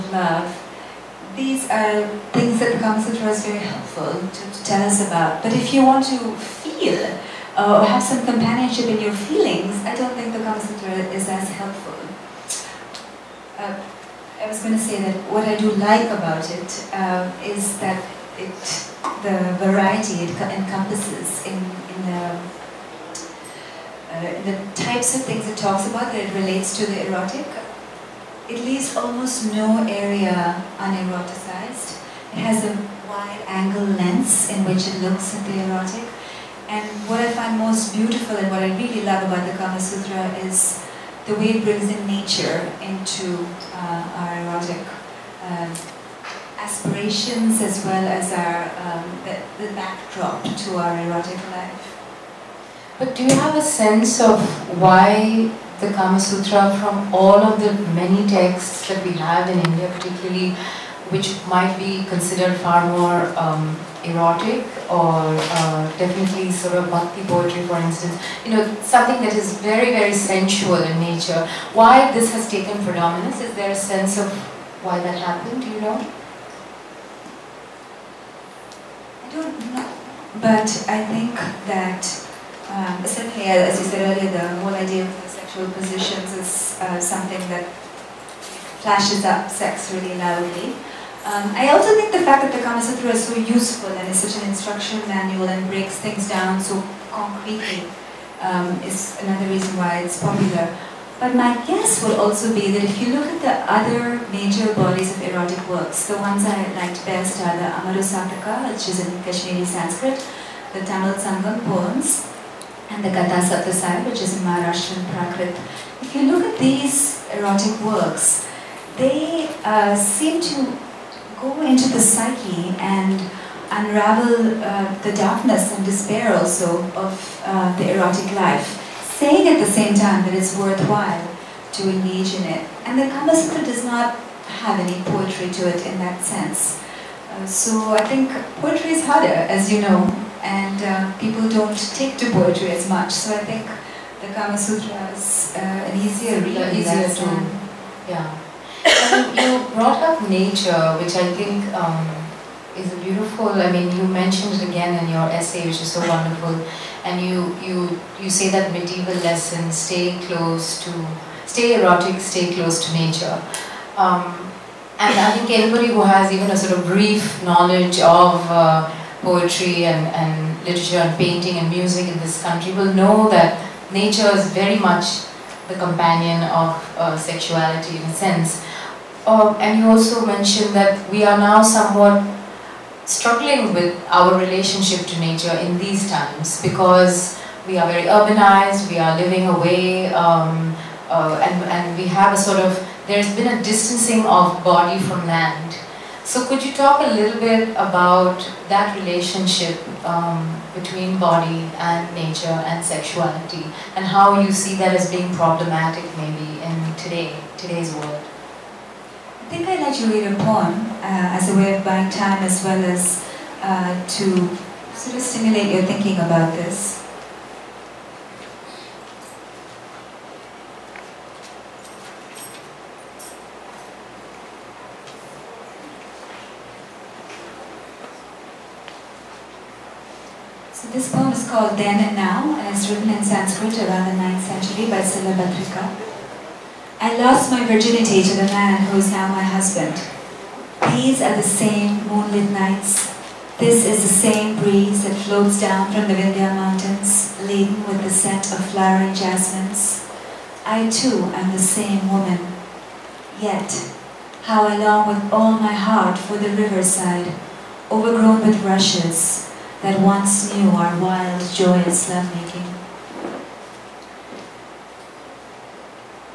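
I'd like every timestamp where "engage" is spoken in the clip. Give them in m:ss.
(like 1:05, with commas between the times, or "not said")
2:11.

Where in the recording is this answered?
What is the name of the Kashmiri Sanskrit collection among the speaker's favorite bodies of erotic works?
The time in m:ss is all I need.
1:47.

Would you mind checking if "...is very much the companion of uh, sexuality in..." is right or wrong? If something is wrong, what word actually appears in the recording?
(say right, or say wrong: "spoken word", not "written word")
right.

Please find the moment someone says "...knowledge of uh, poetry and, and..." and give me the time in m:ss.
2:47.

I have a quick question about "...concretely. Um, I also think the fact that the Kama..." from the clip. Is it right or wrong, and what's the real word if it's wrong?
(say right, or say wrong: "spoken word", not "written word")
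wrong: "loudly", not "concretely".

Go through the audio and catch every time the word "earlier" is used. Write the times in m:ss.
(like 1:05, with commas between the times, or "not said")
1:24.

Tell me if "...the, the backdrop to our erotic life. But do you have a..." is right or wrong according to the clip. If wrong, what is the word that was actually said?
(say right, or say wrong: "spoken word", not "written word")
right.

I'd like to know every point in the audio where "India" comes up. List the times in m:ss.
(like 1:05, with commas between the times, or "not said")
0:59.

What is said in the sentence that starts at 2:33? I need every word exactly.
I mean, you mentioned it again in your essay, which is so wonderful.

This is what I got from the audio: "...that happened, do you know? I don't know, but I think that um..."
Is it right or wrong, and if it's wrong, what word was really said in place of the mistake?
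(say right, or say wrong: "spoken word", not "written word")
right.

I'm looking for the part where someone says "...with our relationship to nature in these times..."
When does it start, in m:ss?
3:03.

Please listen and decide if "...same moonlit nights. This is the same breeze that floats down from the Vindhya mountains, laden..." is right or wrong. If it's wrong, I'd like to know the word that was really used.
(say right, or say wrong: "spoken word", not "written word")
right.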